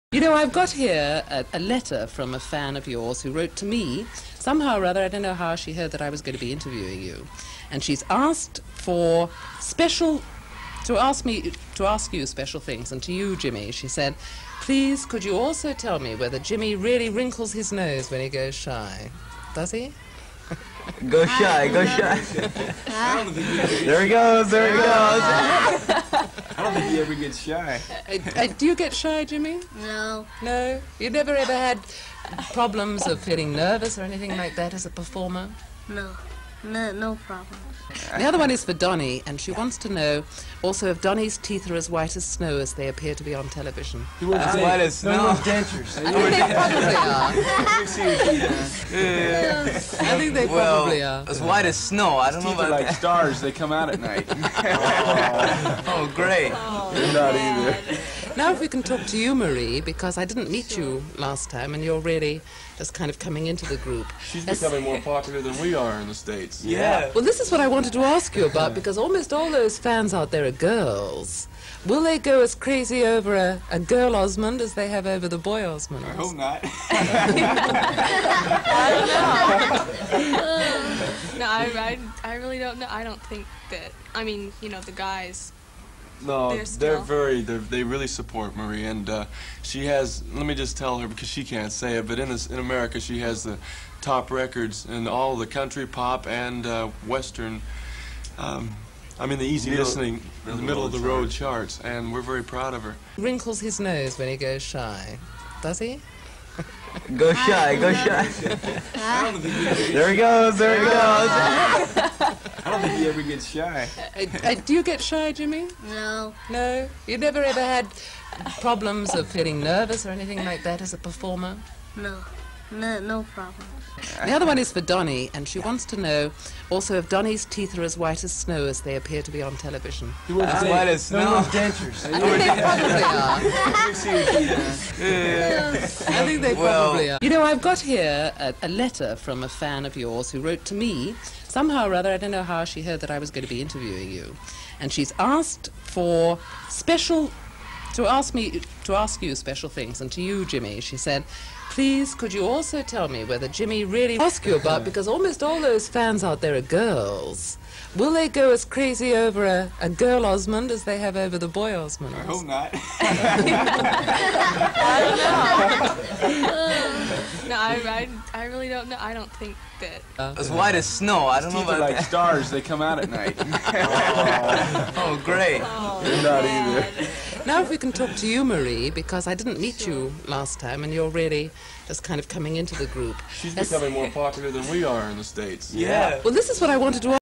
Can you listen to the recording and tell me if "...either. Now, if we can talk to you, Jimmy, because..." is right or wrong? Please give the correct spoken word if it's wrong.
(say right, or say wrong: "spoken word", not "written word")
wrong: "Marie", not "Jimmy".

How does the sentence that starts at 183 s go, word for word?
She's That's becoming more popular than we are in the States.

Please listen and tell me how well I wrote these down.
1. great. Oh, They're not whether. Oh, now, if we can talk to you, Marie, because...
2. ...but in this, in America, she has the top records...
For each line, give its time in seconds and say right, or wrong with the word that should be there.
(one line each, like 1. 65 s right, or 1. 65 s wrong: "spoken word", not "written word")
1. 56 s wrong: "either", not "whether"
2. 92 s right.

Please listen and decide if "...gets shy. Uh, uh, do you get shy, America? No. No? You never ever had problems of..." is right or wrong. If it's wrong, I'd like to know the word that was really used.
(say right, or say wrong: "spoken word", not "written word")
wrong: "Jimmy", not "America".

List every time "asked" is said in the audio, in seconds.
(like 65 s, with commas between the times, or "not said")
8 s, 145 s.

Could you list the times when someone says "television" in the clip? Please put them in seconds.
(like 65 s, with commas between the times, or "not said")
43 s, 129 s.